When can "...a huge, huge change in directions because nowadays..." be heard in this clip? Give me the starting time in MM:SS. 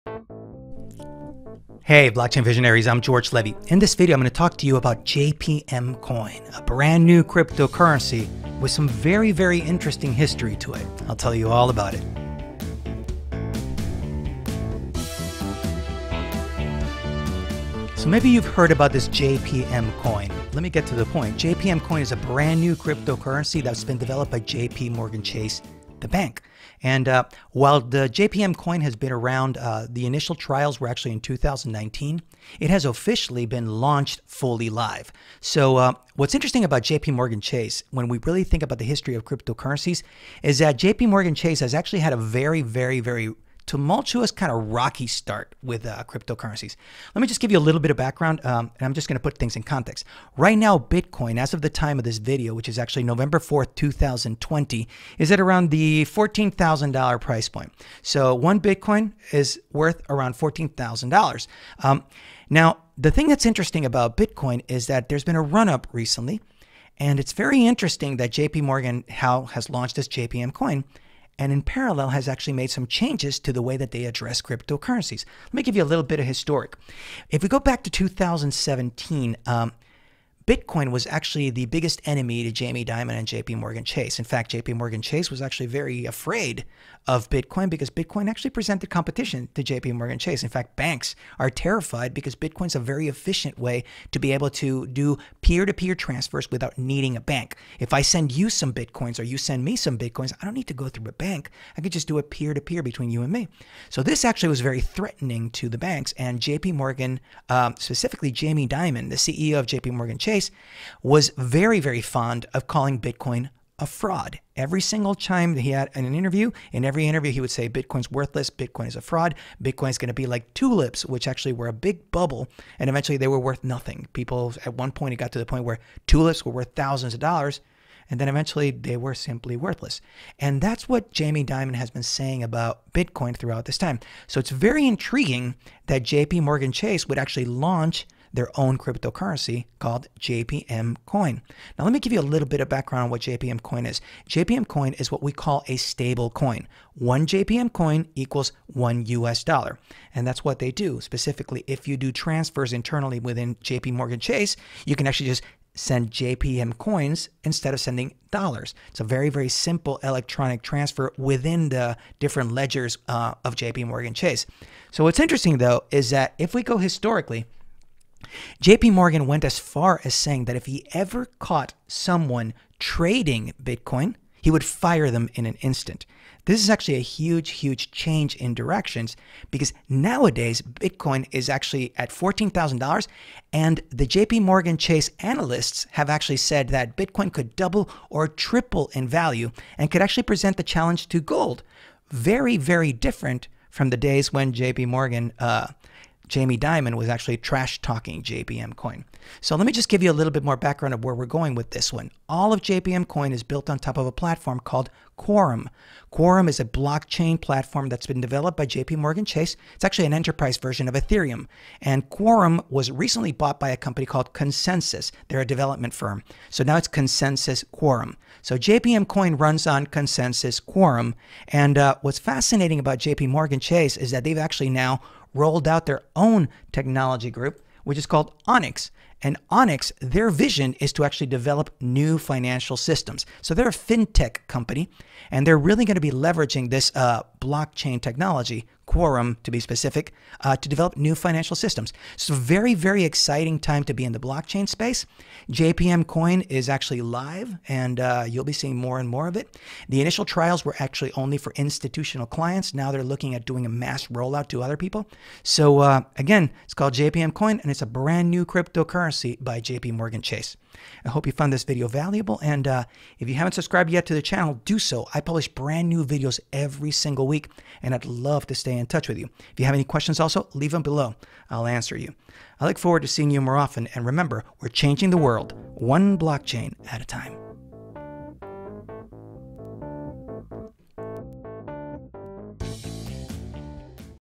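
02:56.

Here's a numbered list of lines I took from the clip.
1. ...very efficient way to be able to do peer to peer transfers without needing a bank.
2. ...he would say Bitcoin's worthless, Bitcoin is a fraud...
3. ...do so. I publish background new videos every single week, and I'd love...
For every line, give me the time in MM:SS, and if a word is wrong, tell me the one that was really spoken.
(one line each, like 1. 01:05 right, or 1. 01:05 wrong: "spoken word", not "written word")
1. 01:32 right
2. 01:57 right
3. 04:24 wrong: "brand", not "background".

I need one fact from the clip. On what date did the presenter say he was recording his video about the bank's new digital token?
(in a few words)
November 4th, 2020.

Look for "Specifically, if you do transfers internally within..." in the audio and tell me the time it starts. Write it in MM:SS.
02:31.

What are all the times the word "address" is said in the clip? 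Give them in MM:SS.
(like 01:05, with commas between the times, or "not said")
01:14.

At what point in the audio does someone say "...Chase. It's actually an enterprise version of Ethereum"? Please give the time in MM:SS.
03:29.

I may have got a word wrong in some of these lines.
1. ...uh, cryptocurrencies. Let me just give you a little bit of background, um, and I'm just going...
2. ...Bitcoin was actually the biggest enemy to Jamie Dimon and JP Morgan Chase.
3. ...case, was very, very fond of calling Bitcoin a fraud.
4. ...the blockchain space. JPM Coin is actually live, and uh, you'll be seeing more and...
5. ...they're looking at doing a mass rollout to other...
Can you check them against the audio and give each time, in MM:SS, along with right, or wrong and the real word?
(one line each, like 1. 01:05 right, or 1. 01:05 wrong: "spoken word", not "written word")
1. 00:45 right
2. 01:20 right
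3. 01:50 right
4. 04:04 right
5. 04:12 right.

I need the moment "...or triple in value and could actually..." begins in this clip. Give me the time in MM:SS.
03:08.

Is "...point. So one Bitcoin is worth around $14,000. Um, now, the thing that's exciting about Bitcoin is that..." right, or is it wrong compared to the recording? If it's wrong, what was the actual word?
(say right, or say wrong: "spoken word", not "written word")
wrong: "interesting", not "exciting".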